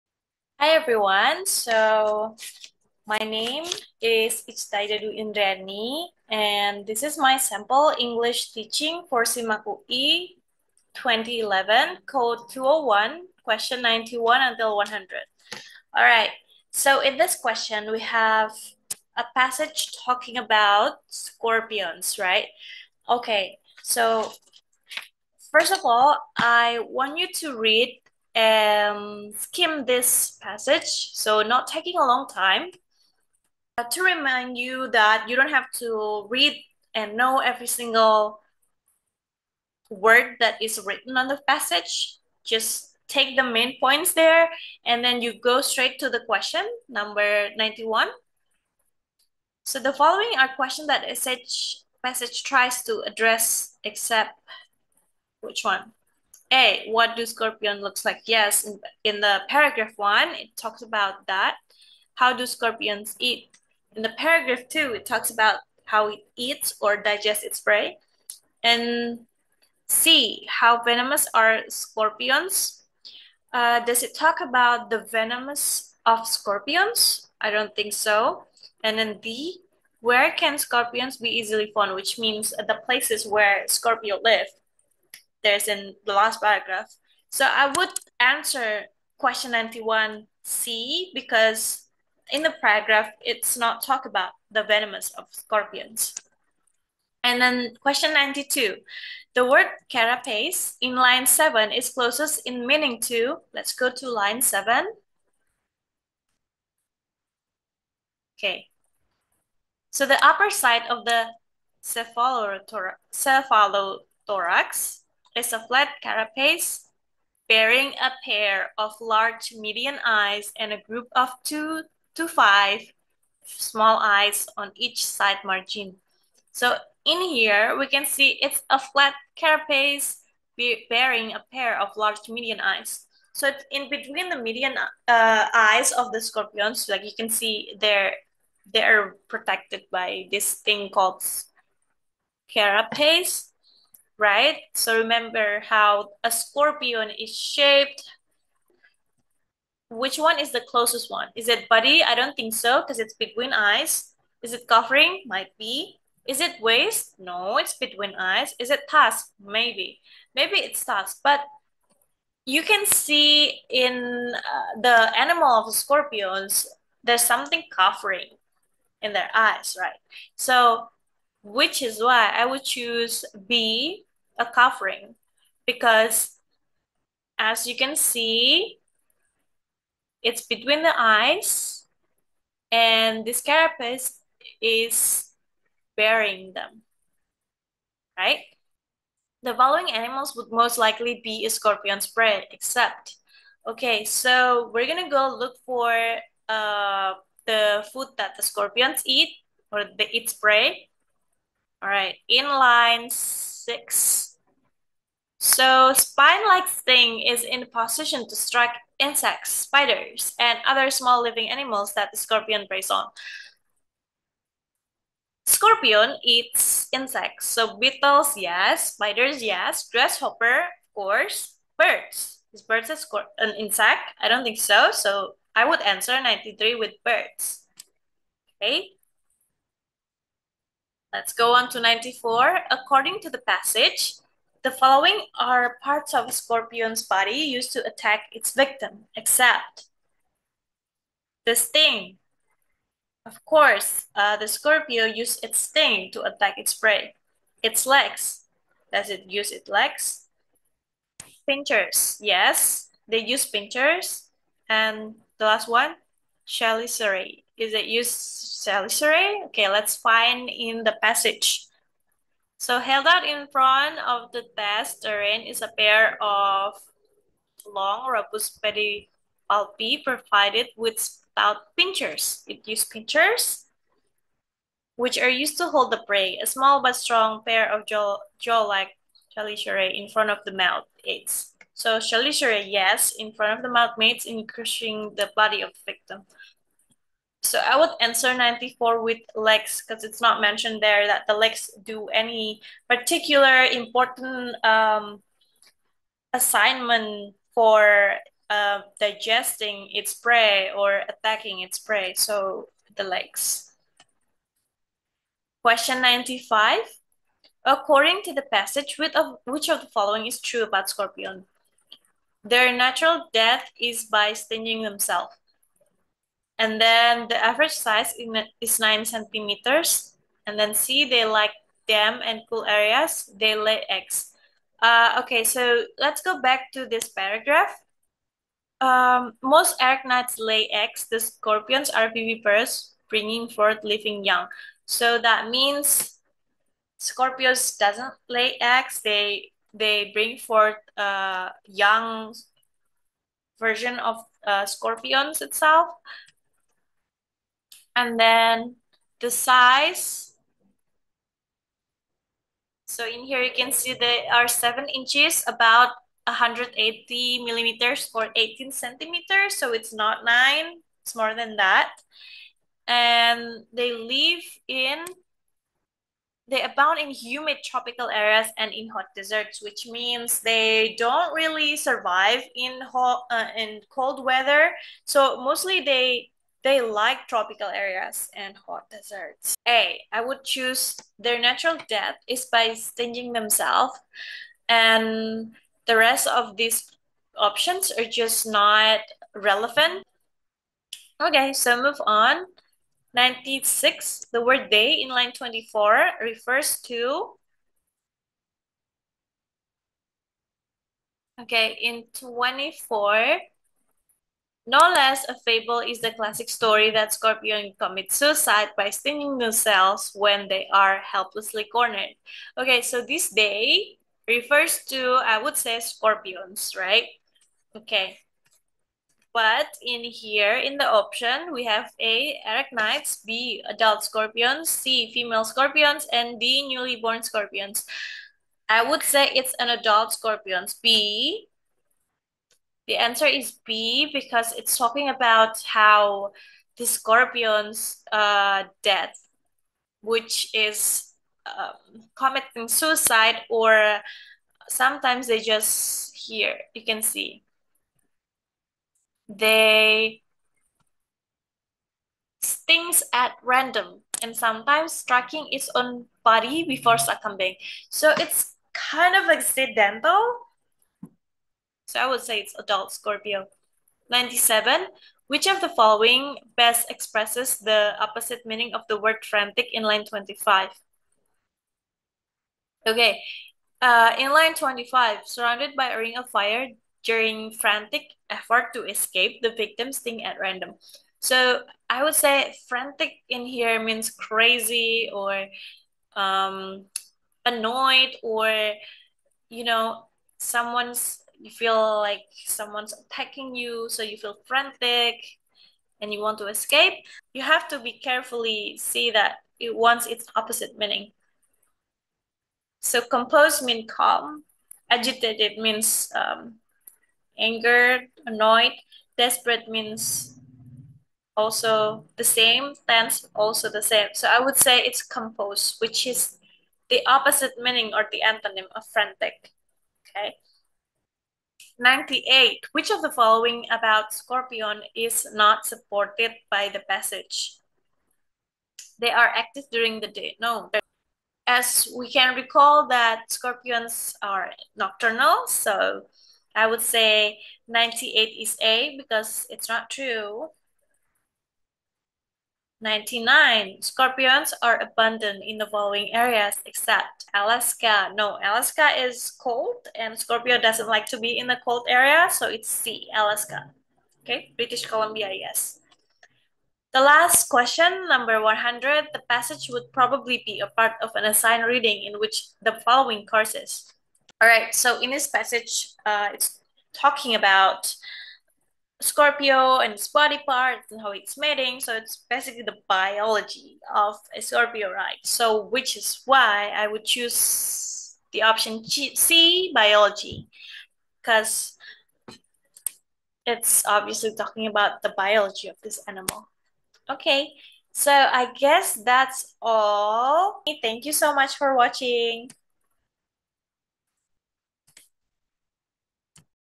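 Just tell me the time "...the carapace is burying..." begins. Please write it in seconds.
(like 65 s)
183 s.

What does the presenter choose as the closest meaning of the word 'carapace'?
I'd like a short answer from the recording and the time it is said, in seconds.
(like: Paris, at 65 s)
a covering, at 174 s.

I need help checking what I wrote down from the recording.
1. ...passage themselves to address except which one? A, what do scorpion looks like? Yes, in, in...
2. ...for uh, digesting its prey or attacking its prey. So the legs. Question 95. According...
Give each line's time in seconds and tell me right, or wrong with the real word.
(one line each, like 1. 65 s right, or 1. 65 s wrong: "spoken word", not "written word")
1. 52 s wrong: "tries", not "themselves"
2. 297 s right.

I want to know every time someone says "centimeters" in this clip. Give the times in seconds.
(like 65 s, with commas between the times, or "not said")
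319 s, 358 s.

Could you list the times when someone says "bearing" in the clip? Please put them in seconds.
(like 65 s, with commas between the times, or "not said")
117 s, 130 s.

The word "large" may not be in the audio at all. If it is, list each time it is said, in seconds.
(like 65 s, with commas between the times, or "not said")
119 s, 131 s.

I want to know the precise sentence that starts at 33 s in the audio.
Uh, to remind you that you don't have to read and know every single word that is written on the passage.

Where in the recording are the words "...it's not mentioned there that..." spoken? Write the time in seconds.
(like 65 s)
290 s.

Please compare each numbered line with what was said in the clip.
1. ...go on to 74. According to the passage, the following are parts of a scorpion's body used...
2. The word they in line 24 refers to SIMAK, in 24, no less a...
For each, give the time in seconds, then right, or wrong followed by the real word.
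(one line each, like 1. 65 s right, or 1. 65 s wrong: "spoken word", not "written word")
1. 231 s wrong: "94", not "74"
2. 394 s wrong: "Okay", not "SIMAK".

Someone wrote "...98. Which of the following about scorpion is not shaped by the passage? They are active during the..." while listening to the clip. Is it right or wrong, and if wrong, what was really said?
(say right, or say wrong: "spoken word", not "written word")
wrong: "supported", not "shaped".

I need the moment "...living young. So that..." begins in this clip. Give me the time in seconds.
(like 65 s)
333 s.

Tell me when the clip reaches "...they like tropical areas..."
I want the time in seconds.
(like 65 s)
376 s.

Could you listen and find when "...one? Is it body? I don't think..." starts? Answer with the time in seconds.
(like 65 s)
151 s.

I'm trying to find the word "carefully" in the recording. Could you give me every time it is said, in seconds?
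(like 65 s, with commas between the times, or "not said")
497 s.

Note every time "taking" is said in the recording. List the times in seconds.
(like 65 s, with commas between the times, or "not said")
31 s.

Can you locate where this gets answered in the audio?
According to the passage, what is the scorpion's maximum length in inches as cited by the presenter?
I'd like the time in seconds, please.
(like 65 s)
354 s.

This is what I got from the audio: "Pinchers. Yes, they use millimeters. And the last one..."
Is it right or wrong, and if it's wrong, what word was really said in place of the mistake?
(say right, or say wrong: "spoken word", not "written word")
wrong: "pinchers", not "millimeters".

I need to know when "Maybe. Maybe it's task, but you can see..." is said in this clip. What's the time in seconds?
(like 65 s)
159 s.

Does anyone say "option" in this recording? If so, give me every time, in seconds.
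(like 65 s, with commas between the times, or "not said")
387 s, 420 s, 578 s.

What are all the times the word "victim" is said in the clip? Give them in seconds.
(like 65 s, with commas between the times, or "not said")
238 s, 285 s, 479 s.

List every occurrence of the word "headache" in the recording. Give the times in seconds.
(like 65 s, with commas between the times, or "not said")
not said.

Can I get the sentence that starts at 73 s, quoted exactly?
Uh, does it talk about the venomous of scorpions?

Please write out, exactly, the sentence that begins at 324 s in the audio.
Uh, okay, so let's go back to this paragraph.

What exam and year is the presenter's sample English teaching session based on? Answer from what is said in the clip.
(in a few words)
SIMAK 2011.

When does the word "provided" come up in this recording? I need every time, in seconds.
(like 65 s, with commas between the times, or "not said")
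270 s.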